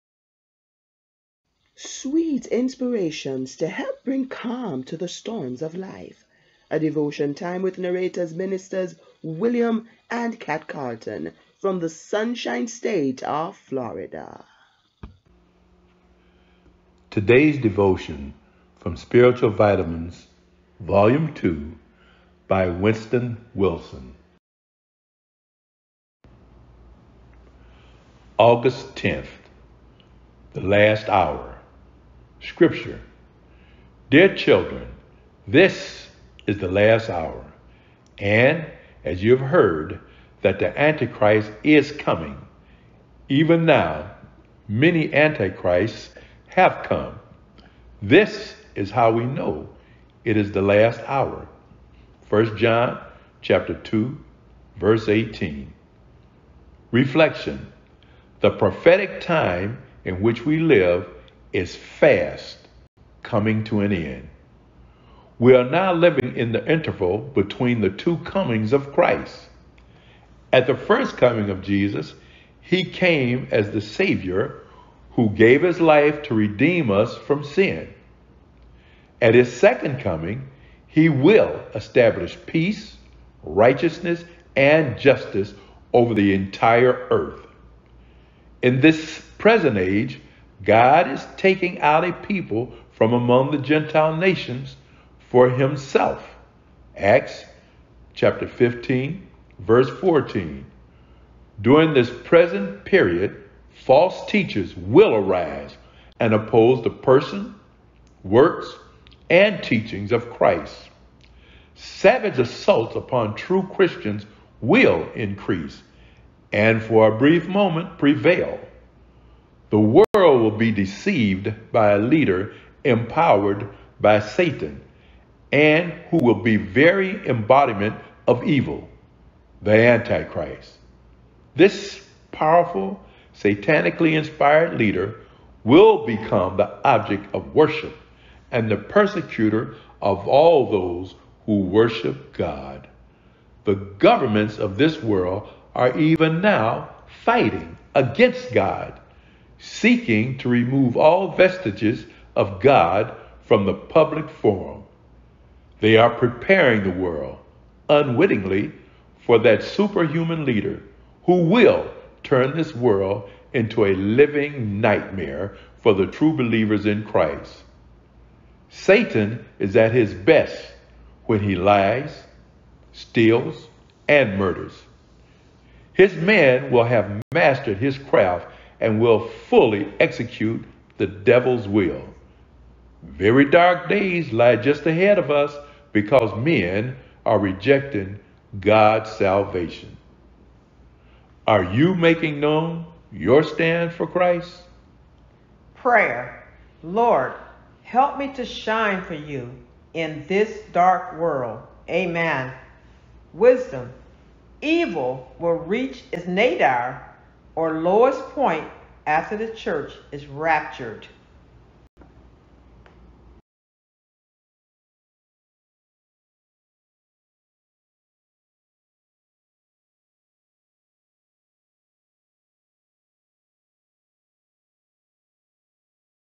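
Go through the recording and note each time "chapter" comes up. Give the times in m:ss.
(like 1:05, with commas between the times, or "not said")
0:53, 1:38.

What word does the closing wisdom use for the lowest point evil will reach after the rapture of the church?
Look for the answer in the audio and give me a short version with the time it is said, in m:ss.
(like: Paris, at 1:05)
nadir, at 3:26.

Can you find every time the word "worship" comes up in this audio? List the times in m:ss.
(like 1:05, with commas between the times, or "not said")
2:17, 2:21.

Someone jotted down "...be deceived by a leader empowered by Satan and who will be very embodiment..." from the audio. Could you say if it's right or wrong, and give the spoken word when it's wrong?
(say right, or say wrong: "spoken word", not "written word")
right.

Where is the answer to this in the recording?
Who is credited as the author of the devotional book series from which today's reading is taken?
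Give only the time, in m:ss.
0:22.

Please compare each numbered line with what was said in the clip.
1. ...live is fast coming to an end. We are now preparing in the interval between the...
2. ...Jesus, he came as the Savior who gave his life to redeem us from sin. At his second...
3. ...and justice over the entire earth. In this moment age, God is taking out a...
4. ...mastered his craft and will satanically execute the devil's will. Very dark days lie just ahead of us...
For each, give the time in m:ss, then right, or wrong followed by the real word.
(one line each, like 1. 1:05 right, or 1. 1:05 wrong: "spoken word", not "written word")
1. 1:00 wrong: "living", not "preparing"
2. 1:11 right
3. 1:24 wrong: "present", not "moment"
4. 2:57 wrong: "fully", not "satanically".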